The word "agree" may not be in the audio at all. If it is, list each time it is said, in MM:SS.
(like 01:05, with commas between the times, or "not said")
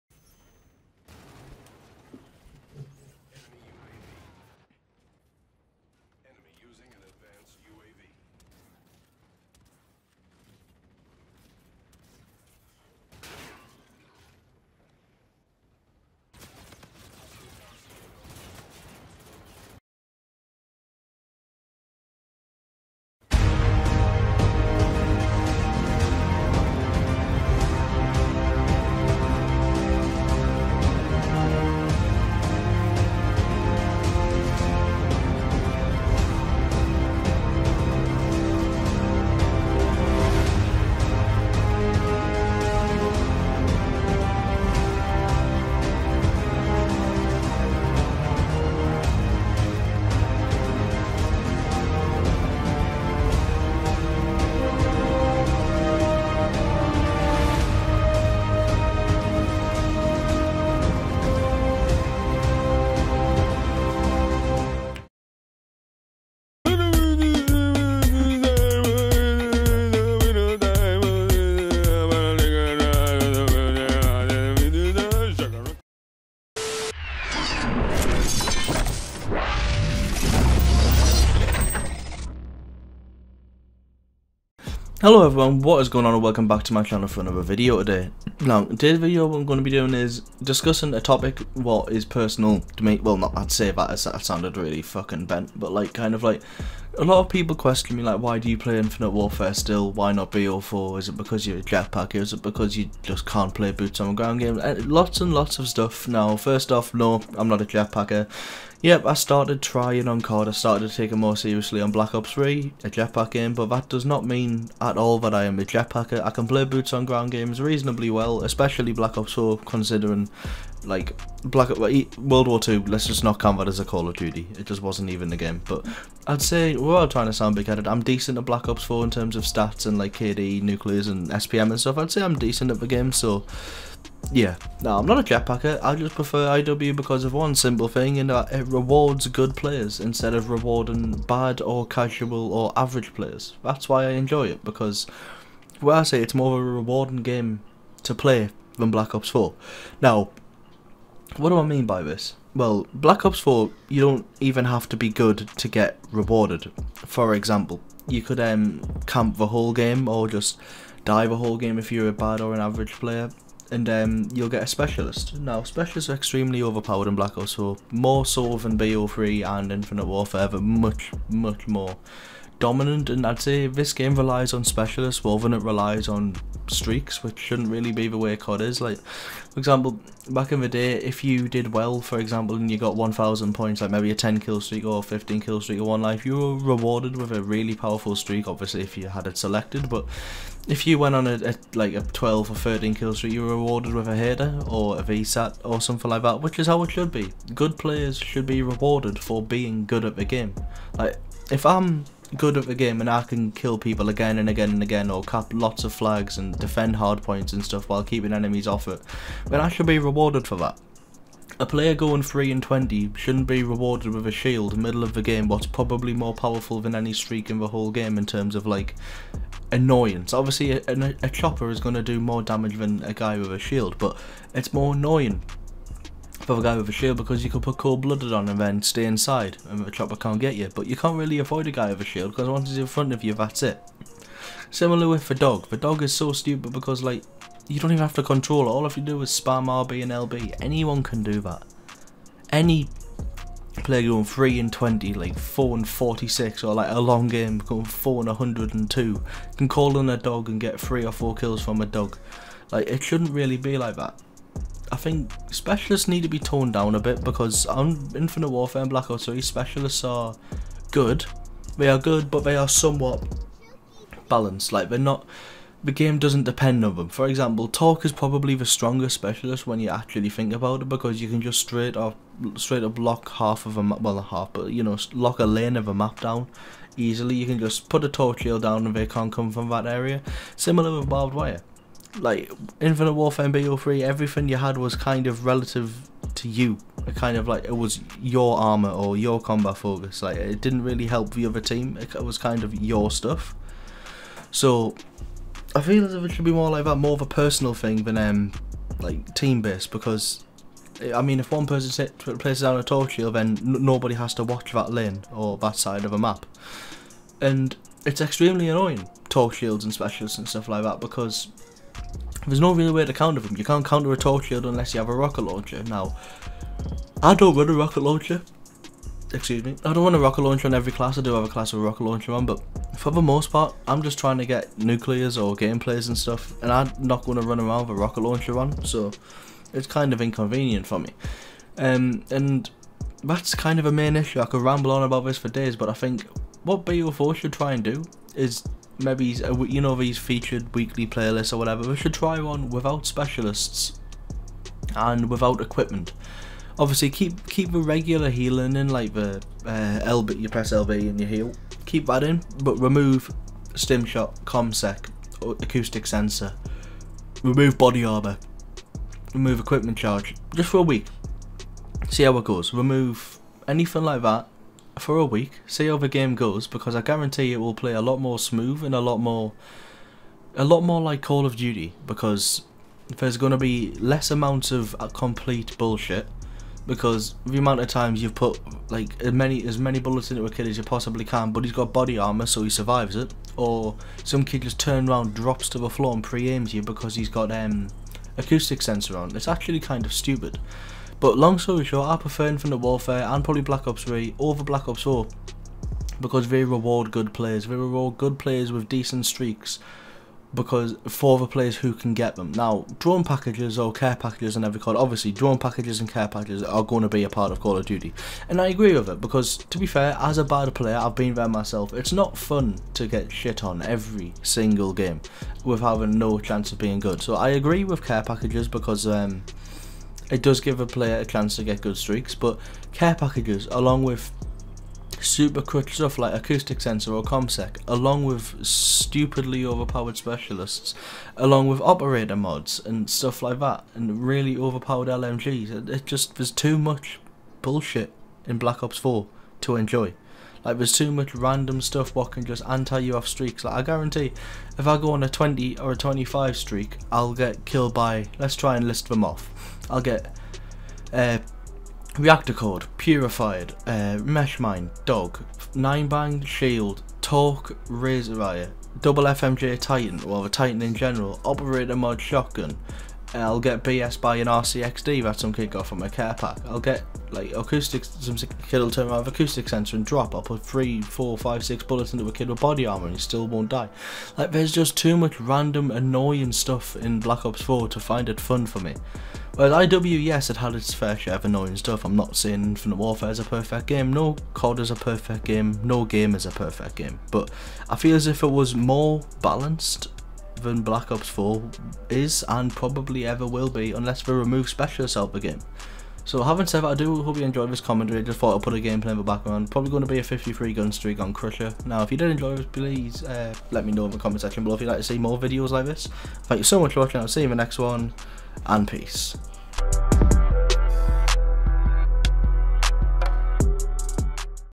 06:48, 06:57.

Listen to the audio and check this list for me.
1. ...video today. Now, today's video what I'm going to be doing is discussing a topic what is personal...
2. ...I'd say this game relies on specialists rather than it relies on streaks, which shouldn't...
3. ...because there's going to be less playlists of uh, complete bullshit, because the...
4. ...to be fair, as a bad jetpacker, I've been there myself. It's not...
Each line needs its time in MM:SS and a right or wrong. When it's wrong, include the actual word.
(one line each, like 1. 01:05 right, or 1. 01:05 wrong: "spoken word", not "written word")
1. 01:27 right
2. 02:53 right
3. 06:12 wrong: "amounts", not "playlists"
4. 06:49 wrong: "player", not "jetpacker".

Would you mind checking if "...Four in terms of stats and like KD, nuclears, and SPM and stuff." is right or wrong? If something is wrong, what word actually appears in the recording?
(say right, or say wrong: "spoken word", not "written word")
right.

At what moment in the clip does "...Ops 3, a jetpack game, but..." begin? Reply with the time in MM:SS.
01:52.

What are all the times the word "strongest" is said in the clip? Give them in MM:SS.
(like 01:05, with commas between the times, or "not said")
04:28.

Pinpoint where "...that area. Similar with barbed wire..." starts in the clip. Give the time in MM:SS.
04:39.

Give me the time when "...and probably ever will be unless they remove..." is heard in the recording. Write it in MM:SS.
08:12.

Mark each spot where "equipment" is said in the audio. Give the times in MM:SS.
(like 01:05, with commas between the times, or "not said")
05:45, 05:59.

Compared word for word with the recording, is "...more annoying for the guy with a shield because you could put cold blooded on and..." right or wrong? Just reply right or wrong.
right.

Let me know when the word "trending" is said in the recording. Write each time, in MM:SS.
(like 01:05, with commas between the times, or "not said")
not said.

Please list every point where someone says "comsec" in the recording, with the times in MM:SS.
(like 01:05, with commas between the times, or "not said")
05:54, 07:07.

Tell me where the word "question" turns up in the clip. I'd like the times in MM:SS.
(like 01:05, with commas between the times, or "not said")
01:37.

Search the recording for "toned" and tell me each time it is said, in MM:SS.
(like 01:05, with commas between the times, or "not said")
04:16.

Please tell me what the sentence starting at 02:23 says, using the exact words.
That's why I enjoy it because, well, I say it's more of a rewarding game to play than Black Ops 4.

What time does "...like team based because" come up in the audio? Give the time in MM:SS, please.
04:58.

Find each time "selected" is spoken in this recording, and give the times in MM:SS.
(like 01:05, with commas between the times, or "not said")
03:09.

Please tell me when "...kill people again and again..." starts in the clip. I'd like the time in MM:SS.
03:23.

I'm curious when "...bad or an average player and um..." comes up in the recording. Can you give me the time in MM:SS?
02:42.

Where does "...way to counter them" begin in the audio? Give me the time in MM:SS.
05:12.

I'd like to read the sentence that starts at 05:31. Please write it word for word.
Um, and that's kind of a main issue.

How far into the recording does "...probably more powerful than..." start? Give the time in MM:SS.
03:35.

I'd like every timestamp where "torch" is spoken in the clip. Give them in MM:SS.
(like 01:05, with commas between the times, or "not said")
05:02, 05:09, 05:14.